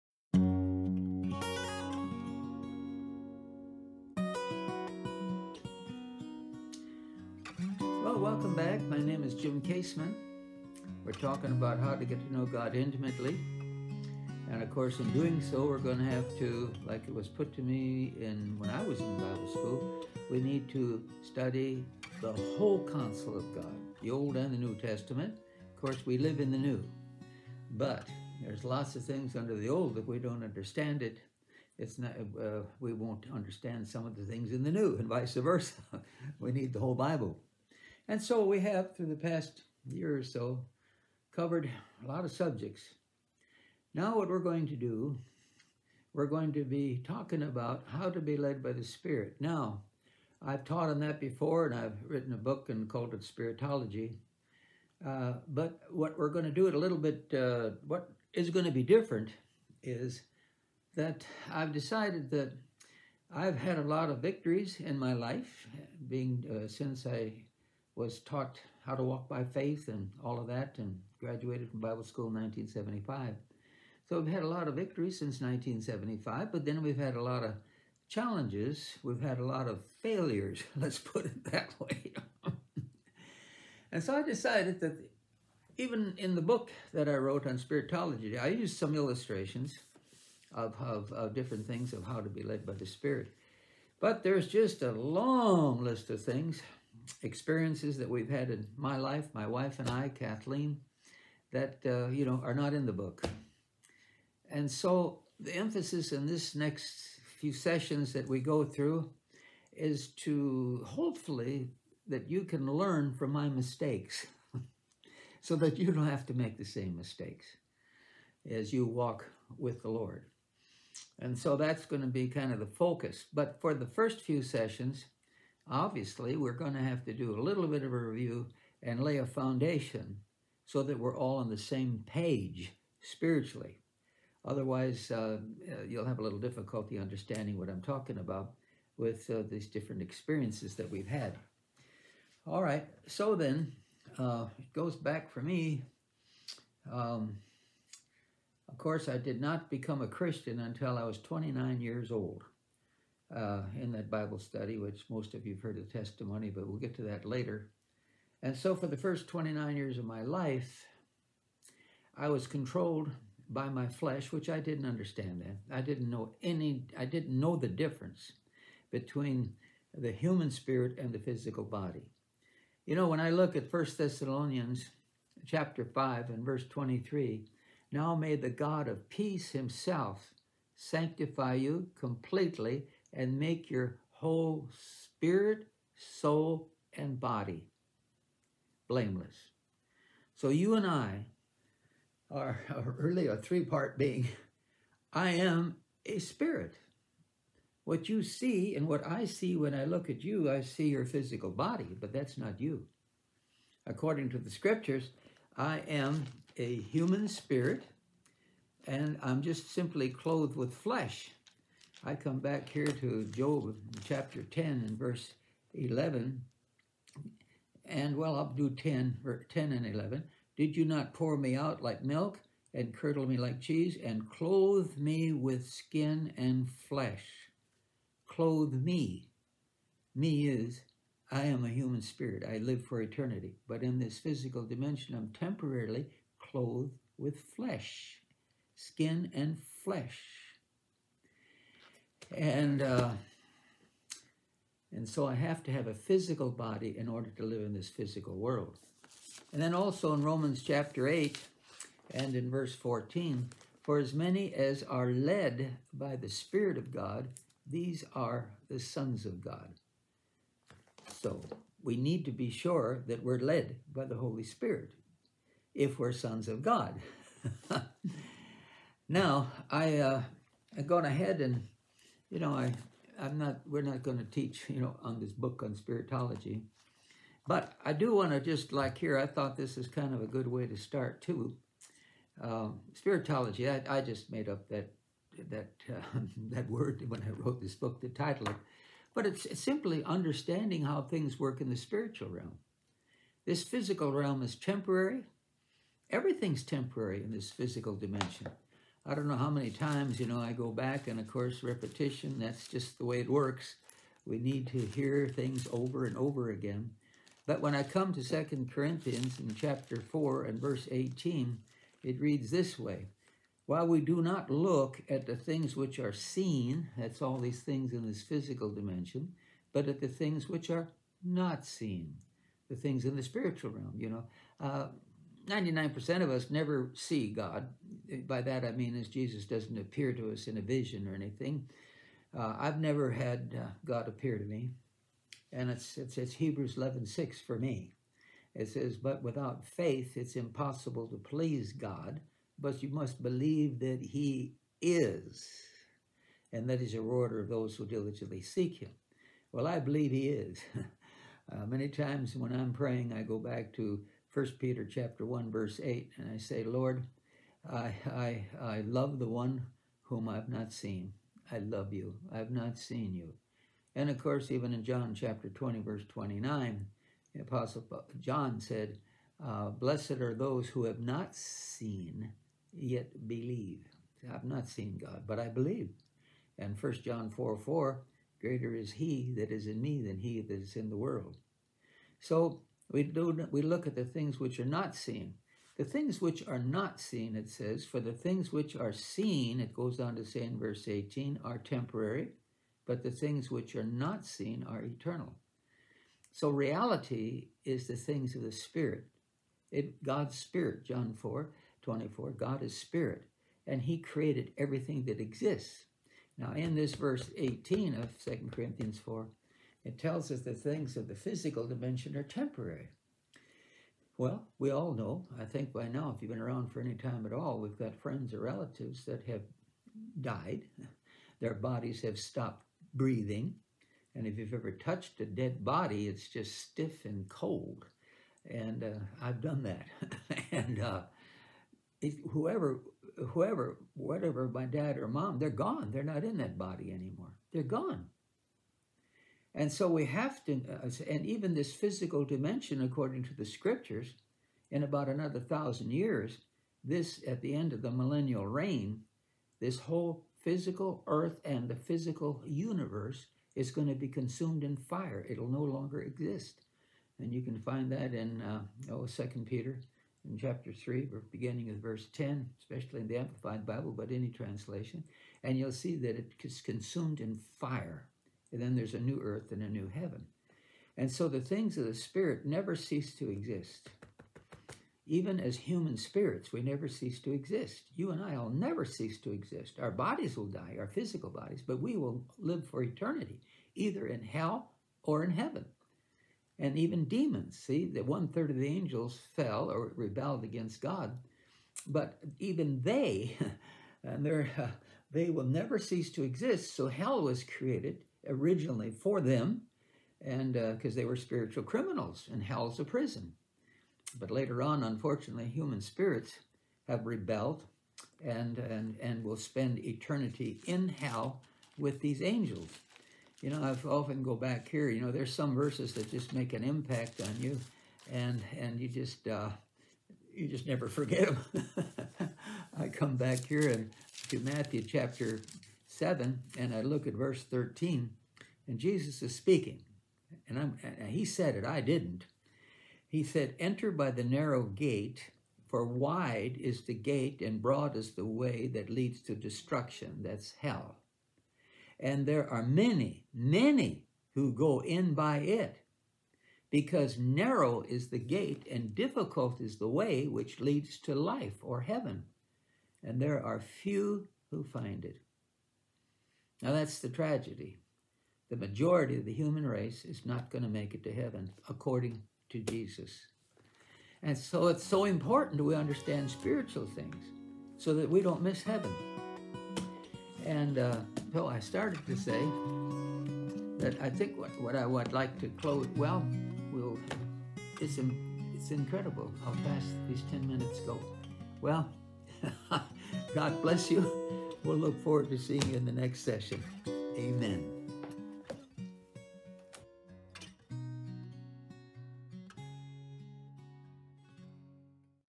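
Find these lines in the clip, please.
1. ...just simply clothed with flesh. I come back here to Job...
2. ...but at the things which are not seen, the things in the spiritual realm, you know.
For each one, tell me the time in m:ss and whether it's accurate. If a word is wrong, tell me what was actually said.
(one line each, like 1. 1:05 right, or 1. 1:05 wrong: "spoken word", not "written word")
1. 3:29 right
2. 5:19 right.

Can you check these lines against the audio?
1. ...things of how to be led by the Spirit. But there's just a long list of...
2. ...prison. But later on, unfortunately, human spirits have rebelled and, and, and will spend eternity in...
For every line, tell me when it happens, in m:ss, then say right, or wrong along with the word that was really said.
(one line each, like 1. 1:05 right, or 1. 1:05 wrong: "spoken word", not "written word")
1. 1:31 right
2. 8:22 right.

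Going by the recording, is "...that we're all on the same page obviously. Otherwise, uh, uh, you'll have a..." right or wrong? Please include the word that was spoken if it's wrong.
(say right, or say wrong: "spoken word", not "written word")
wrong: "spiritually", not "obviously".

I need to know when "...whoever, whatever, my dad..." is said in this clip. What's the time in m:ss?
7:13.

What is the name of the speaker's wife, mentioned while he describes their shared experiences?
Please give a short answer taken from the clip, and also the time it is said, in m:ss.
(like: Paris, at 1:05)
Kathleen, at 1:40.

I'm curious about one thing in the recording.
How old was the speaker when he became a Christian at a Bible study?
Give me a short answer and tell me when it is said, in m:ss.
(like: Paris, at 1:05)
29, at 2:30.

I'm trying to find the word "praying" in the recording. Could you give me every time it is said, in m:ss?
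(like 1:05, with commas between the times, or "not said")
5:52.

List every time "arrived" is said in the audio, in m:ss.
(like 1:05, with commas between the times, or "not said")
not said.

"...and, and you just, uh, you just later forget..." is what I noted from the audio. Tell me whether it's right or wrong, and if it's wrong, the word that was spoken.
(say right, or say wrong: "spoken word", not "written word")
wrong: "never", not "later".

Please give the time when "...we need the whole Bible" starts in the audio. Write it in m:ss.
0:36.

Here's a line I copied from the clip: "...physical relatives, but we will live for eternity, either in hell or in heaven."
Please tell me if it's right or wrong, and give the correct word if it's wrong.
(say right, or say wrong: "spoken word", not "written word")
wrong: "bodies", not "relatives".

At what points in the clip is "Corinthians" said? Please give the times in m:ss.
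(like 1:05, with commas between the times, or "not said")
5:08, 6:48.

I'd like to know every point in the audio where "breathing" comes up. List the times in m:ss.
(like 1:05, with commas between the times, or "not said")
7:02.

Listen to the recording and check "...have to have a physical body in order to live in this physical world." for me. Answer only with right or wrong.
right.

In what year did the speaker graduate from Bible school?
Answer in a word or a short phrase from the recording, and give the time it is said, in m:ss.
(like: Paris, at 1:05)
1975, at 1:11.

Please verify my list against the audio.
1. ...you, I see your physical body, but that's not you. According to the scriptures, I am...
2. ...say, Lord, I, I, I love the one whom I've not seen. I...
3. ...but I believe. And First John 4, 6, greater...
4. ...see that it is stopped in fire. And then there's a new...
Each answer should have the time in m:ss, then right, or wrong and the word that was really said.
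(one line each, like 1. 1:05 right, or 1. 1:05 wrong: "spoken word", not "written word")
1. 3:20 right
2. 5:56 right
3. 6:15 wrong: "4", not "6"
4. 7:45 wrong: "consumed", not "stopped".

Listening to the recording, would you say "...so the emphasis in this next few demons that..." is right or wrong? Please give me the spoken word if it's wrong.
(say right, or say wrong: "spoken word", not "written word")
wrong: "sessions", not "demons".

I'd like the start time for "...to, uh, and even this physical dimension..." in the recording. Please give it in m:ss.
7:20.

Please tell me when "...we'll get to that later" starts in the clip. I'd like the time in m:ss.
2:36.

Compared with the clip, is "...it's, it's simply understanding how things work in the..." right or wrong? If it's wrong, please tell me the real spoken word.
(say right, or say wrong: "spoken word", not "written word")
right.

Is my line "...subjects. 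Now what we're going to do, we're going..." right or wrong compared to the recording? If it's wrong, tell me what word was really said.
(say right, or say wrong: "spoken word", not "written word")
right.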